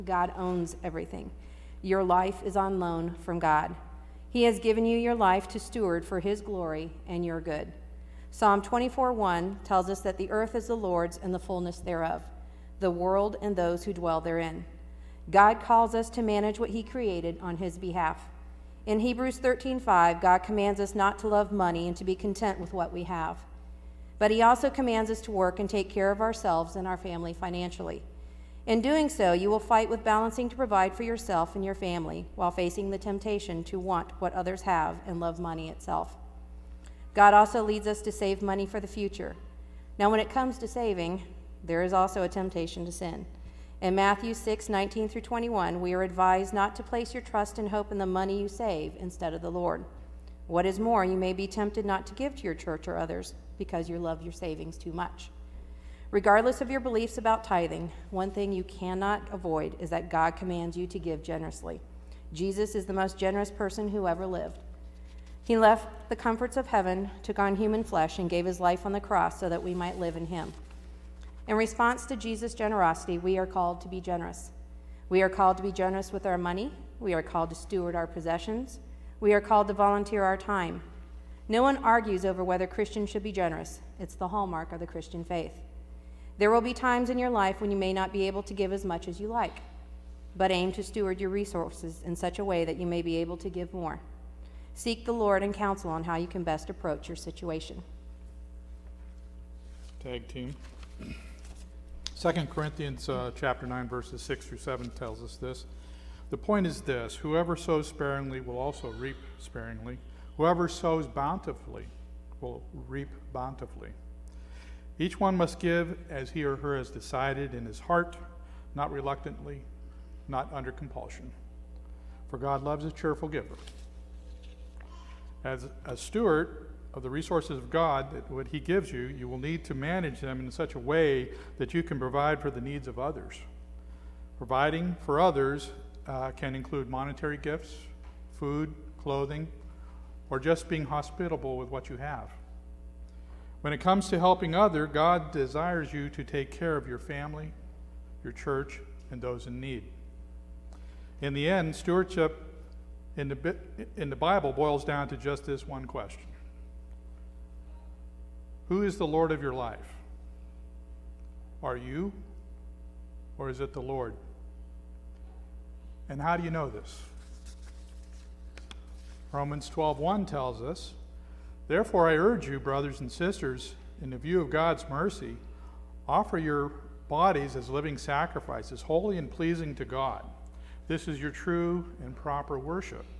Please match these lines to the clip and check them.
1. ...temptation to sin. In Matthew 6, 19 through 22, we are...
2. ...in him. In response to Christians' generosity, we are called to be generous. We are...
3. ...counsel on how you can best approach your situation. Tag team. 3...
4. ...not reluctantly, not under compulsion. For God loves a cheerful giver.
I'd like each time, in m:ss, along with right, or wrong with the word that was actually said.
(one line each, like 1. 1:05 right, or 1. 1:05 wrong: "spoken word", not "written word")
1. 0:42 wrong: "21", not "22"
2. 1:10 wrong: "Jesus", not "Christians"
3. 1:35 wrong: "2", not "3"
4. 1:58 right.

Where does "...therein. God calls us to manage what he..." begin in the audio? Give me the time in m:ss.
0:14.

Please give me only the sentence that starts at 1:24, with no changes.
It's the hallmark of the Christian faith.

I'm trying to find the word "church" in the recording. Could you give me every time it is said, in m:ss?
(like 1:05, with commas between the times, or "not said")
0:52, 2:28.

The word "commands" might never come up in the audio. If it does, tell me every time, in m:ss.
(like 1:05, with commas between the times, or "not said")
0:20, 0:24, 1:00.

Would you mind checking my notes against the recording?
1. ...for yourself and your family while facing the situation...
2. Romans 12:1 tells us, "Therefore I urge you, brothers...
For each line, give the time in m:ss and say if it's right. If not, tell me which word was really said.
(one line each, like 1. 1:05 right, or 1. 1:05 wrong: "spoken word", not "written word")
1. 0:30 wrong: "temptation", not "situation"
2. 2:49 right.